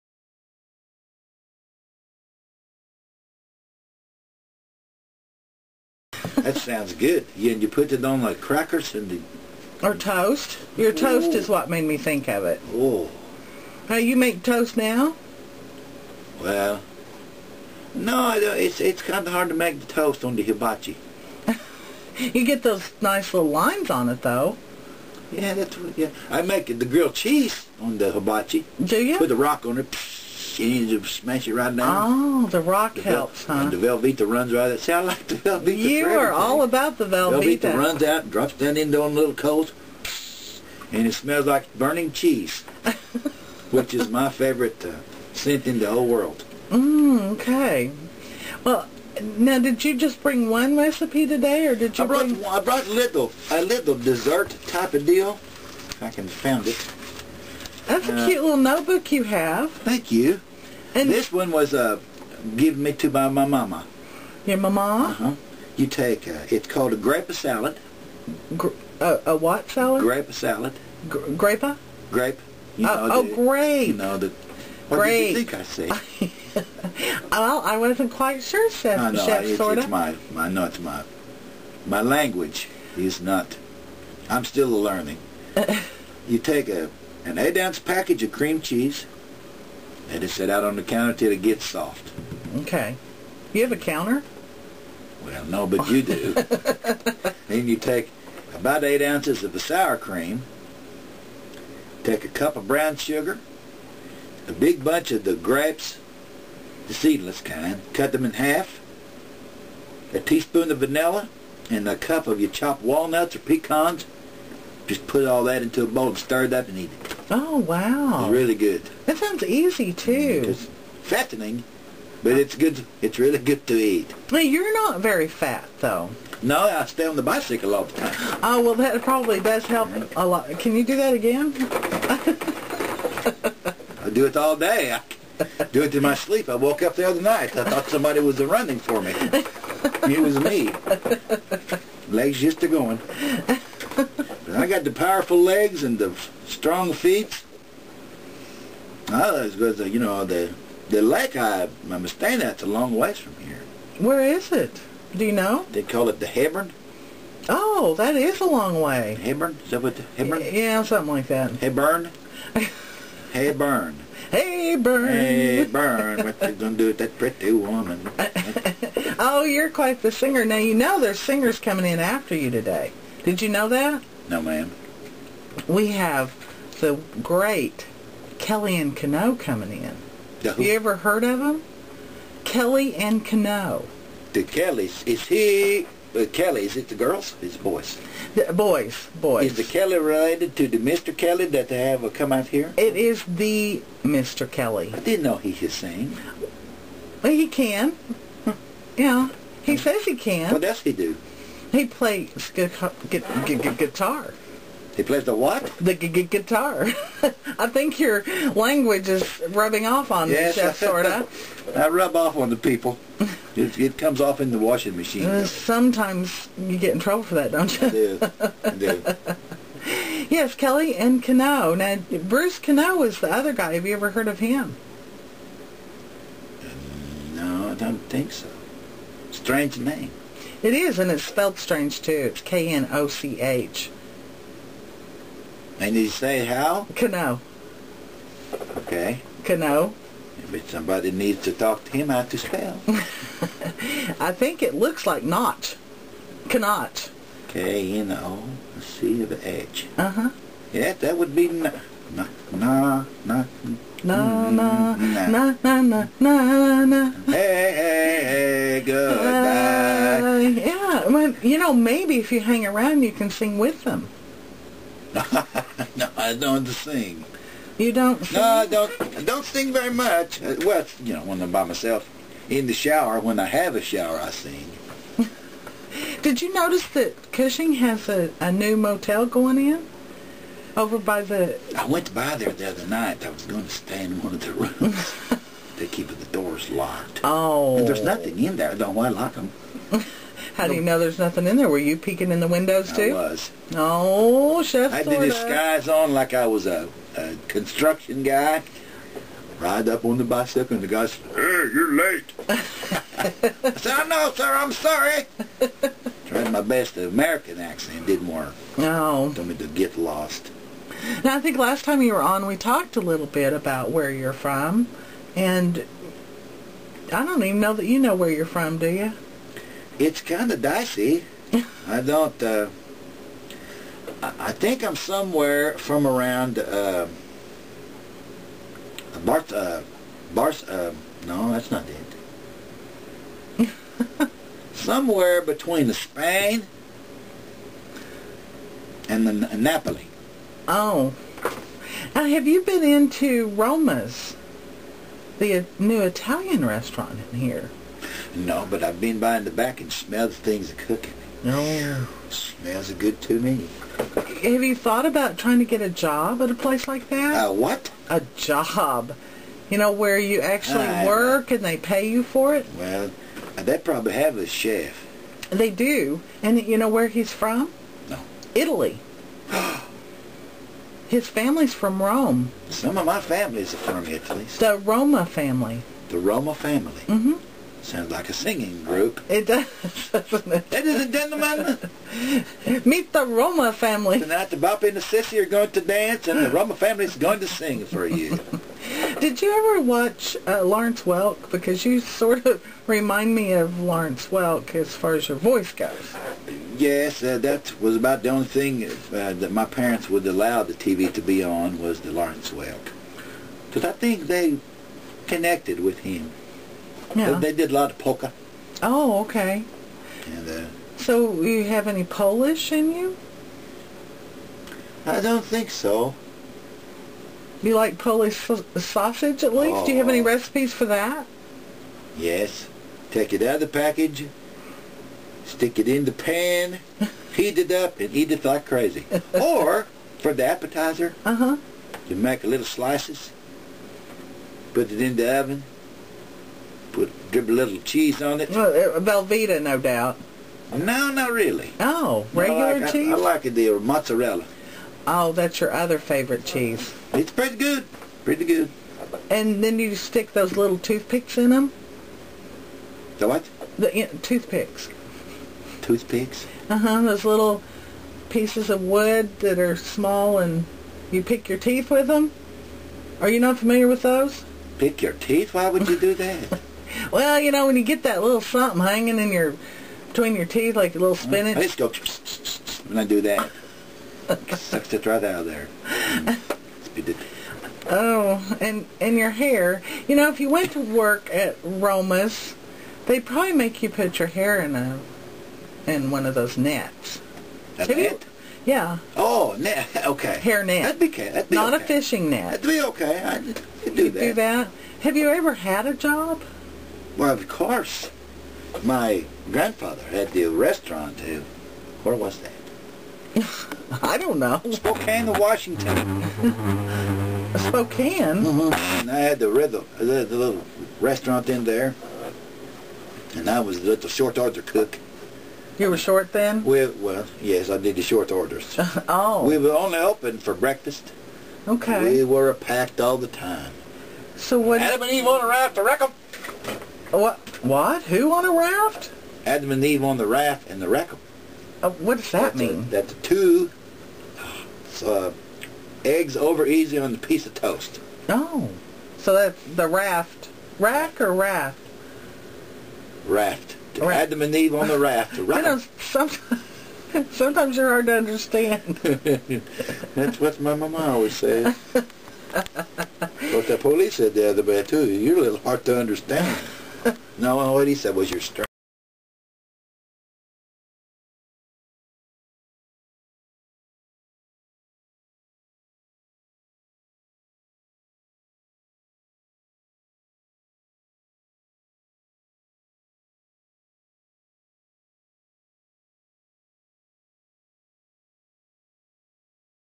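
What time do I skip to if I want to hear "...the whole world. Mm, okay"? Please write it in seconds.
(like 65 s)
45 s.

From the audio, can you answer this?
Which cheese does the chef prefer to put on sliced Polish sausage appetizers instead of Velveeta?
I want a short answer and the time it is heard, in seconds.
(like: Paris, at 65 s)
Mozzarella, at 443 s.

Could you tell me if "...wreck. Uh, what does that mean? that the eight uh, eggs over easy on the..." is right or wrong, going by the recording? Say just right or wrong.
wrong.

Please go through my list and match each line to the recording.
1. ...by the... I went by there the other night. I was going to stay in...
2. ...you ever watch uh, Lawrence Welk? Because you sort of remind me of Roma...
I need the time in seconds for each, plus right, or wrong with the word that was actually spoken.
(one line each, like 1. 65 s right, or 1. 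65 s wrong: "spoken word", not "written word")
1. 280 s right
2. 389 s wrong: "Lawrence", not "Roma".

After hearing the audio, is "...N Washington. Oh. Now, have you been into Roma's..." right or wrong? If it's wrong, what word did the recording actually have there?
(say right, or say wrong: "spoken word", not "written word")
wrong: "Napoli", not "Washington".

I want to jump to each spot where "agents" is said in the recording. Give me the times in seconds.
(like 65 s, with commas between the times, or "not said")
not said.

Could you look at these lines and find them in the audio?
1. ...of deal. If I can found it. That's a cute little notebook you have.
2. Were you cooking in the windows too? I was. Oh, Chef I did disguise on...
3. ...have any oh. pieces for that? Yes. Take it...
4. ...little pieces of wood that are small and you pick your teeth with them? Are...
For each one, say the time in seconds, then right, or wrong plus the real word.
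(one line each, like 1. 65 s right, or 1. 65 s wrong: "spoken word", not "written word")
1. 54 s right
2. 291 s wrong: "peeking", not "cooking"
3. 419 s wrong: "recipes", not "pieces"
4. 457 s right.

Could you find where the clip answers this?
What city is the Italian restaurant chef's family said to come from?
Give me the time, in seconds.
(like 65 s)
372 s.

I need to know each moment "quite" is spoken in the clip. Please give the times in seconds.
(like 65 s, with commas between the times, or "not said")
78 s, 169 s.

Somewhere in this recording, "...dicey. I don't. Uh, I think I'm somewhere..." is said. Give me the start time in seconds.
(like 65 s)
320 s.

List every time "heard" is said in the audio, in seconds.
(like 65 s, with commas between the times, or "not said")
180 s, 224 s.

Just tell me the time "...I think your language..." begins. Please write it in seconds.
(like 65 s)
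207 s.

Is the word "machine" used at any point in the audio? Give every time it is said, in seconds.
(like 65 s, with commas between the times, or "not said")
214 s.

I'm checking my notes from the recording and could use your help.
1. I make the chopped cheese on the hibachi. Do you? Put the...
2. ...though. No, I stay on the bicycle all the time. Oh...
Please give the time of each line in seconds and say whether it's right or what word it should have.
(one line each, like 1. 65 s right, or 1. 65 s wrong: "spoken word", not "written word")
1. 26 s wrong: "grilled", not "chopped"
2. 125 s right.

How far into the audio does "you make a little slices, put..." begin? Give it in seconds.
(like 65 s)
432 s.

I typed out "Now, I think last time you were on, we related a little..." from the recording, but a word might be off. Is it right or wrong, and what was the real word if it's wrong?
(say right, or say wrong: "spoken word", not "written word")
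wrong: "talked", not "related".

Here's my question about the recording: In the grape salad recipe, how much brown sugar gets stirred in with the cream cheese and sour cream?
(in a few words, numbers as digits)
1 cup.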